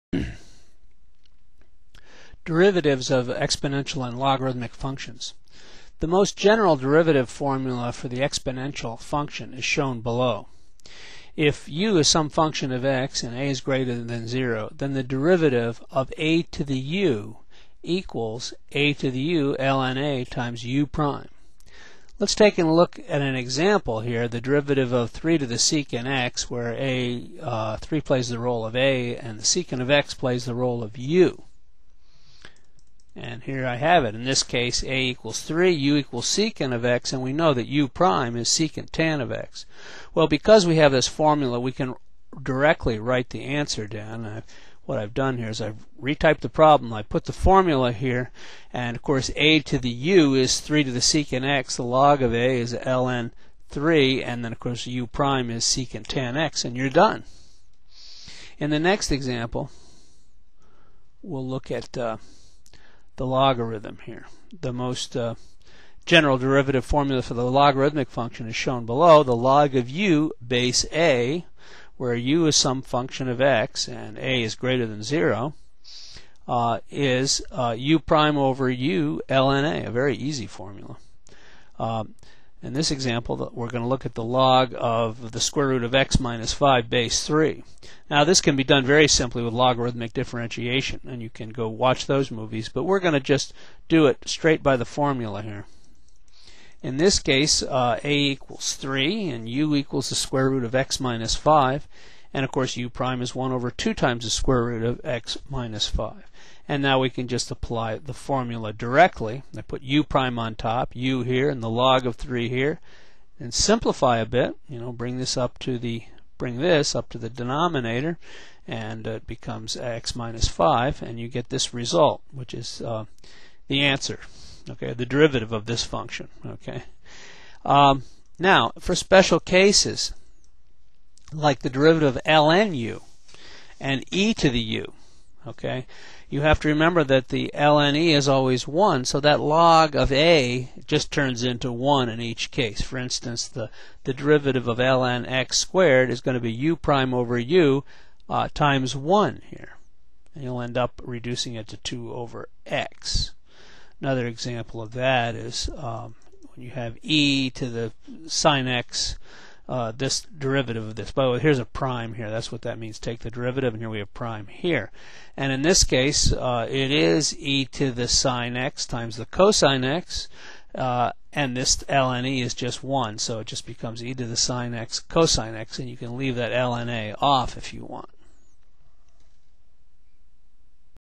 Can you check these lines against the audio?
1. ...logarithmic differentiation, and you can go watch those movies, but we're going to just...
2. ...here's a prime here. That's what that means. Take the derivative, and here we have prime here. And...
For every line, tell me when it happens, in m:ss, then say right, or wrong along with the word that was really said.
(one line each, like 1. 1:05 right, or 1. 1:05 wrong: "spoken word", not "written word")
1. 1:29 right
2. 2:41 right.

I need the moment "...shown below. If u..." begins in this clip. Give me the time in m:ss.
0:09.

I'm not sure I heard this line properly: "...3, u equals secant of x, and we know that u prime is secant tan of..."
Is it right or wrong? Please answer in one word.
right.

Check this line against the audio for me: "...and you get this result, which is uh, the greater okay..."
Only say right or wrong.
wrong.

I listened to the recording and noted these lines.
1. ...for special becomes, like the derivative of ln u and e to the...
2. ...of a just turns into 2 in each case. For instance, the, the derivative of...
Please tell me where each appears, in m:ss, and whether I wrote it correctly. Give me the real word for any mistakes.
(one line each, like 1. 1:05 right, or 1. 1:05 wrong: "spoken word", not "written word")
1. 2:08 wrong: "cases", not "becomes"
2. 2:19 wrong: "1", not "2".